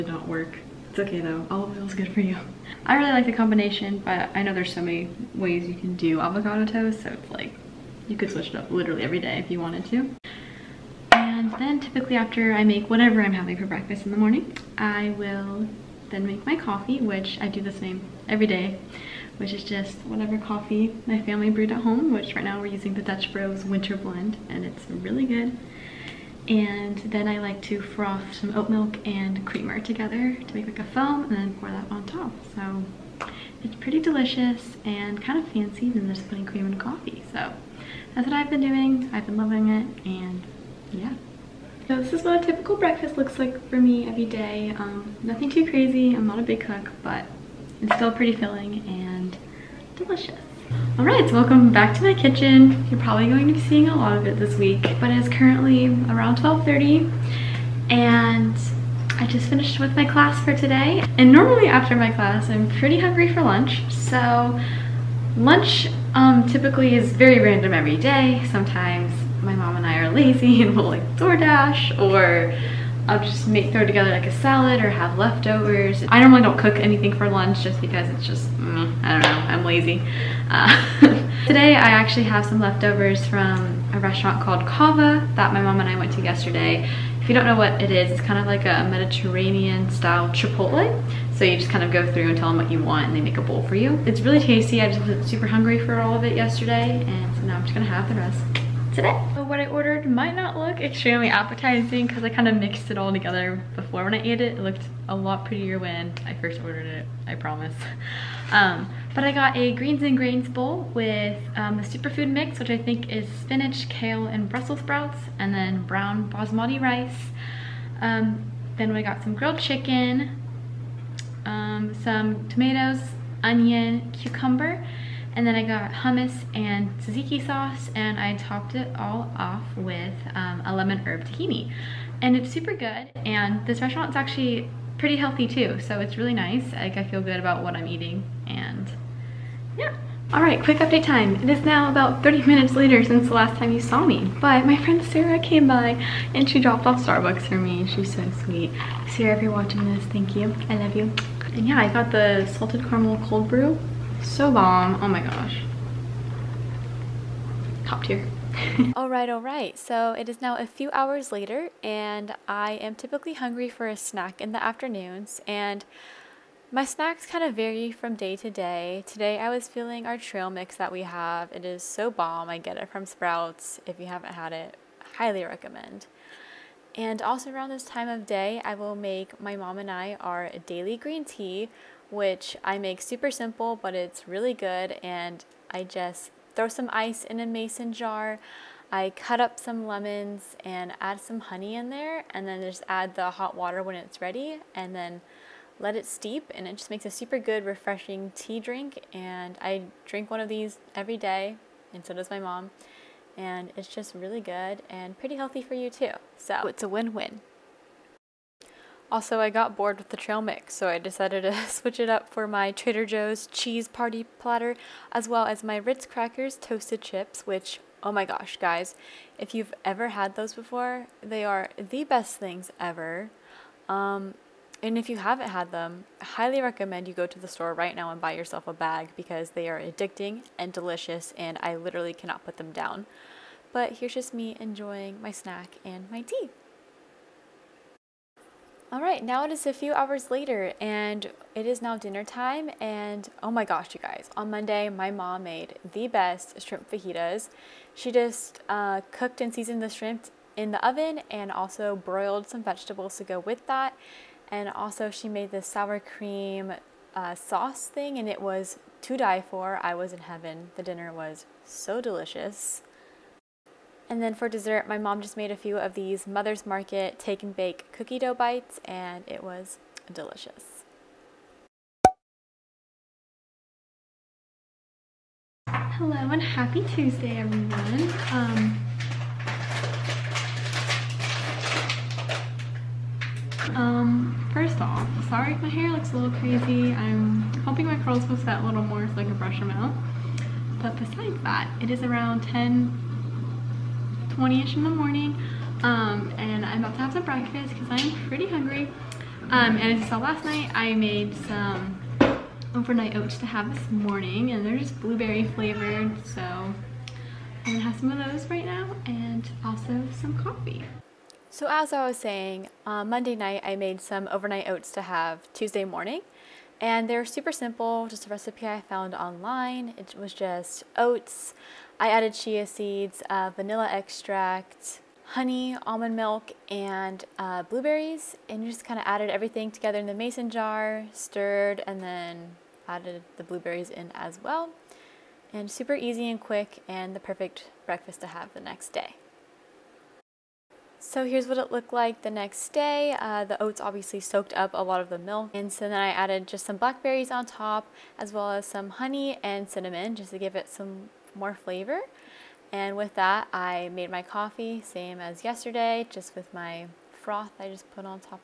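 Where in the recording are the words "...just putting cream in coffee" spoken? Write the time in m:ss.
0:36.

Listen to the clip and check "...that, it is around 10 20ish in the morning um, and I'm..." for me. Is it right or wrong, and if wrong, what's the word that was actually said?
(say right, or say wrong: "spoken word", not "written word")
right.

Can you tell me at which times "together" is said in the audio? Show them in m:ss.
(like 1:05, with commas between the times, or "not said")
0:29, 1:13, 1:43, 5:29.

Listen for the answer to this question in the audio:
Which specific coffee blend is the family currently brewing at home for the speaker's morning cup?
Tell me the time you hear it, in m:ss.
0:23.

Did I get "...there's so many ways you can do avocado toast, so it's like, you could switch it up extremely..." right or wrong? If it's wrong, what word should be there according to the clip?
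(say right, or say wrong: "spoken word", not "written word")
wrong: "literally", not "extremely".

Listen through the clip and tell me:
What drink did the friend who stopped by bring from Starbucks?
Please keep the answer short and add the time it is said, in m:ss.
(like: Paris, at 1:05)
Salted caramel cold brew, at 2:32.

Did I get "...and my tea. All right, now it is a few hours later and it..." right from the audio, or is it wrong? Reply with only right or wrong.
right.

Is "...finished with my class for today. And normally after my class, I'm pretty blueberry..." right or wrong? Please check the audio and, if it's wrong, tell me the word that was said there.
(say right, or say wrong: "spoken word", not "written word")
wrong: "hungry", not "blueberry".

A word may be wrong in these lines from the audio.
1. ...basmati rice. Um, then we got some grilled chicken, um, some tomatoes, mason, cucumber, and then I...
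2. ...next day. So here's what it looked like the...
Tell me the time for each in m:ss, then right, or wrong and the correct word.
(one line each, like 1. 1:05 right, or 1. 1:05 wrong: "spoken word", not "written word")
1. 1:56 wrong: "onion", not "mason"
2. 5:38 right.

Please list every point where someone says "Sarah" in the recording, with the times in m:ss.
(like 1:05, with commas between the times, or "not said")
2:25, 2:29.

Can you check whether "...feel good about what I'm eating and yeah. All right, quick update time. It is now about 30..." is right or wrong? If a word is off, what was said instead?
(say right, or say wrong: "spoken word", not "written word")
right.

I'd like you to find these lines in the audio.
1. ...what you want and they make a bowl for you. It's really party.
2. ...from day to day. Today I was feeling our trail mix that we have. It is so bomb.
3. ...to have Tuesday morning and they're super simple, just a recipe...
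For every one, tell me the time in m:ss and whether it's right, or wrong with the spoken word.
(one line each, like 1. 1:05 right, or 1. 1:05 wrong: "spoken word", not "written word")
1. 1:32 wrong: "tasty", not "party"
2. 2:47 right
3. 5:14 right.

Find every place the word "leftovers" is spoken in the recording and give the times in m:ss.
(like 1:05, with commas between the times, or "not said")
1:15, 1:22.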